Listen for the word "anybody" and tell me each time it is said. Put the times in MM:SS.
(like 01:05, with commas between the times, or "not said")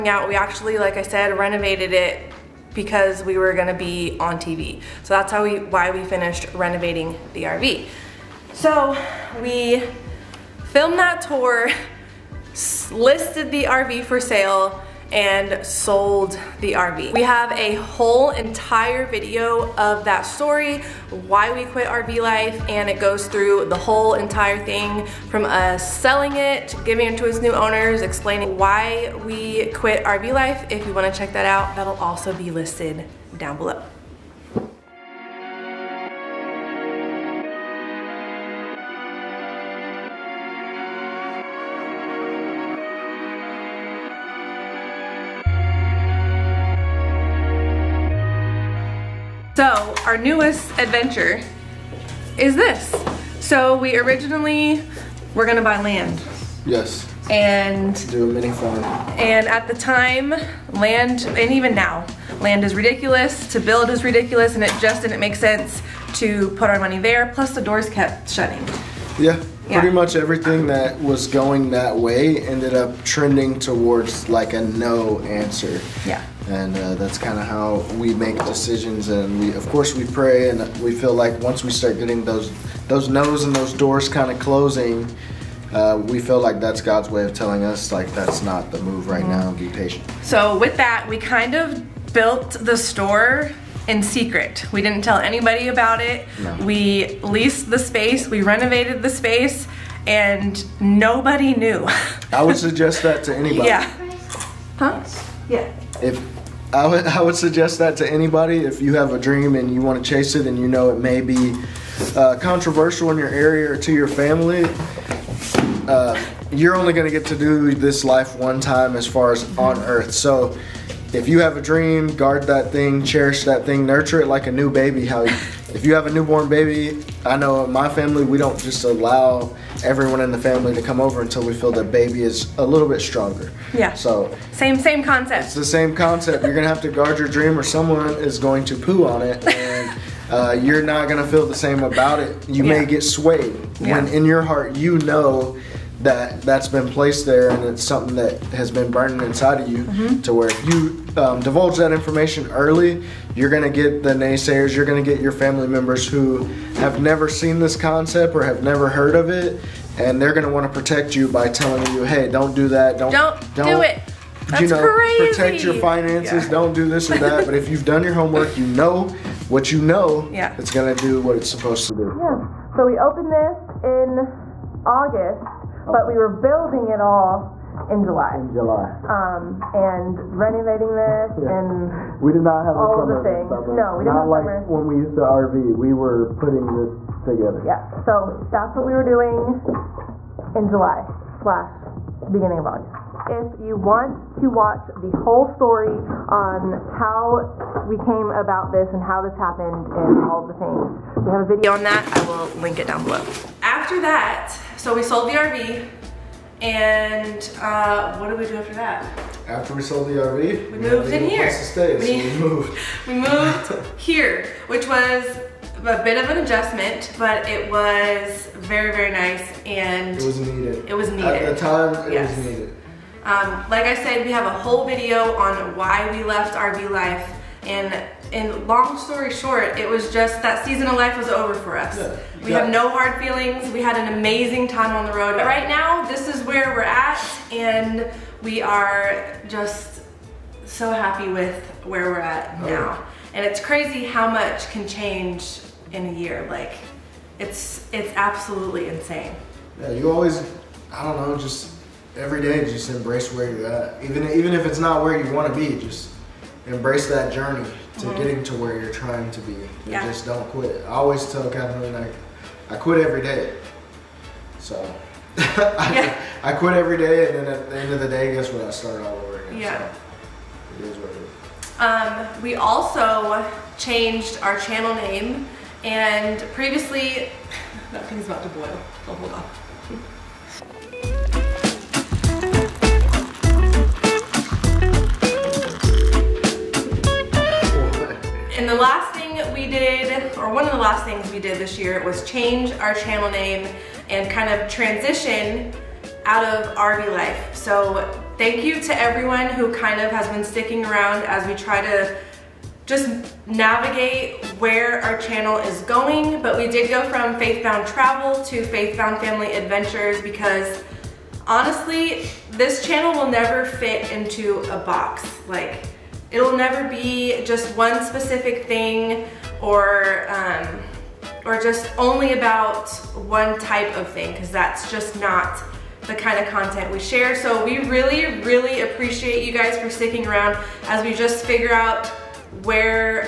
01:35, 01:43, 01:48.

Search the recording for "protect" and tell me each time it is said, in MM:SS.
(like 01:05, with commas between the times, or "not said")
02:40, 02:45.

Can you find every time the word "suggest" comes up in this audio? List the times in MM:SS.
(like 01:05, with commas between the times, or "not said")
01:42, 01:47.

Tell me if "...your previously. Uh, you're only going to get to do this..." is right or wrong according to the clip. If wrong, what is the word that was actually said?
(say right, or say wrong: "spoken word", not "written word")
wrong: "family", not "previously".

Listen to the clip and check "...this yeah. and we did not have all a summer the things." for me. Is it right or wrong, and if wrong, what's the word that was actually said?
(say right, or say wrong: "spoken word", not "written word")
right.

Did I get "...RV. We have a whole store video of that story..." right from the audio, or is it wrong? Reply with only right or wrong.
wrong.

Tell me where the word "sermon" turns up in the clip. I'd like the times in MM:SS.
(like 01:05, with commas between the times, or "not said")
not said.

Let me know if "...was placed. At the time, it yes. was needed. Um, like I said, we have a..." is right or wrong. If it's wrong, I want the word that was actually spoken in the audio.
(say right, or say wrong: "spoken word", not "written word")
wrong: "needed", not "placed".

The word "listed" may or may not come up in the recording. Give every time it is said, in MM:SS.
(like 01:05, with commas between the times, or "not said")
00:12, 00:32.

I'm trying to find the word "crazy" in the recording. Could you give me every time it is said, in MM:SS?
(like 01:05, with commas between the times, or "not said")
02:44, 04:03.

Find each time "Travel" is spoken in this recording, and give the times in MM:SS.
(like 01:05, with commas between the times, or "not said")
05:07.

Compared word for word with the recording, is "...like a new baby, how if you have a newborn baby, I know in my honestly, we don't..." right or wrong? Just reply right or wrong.
wrong.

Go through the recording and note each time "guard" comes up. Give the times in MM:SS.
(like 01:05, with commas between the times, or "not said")
02:02, 02:16.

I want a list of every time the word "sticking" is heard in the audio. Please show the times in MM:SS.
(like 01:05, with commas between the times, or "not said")
05:00, 05:29.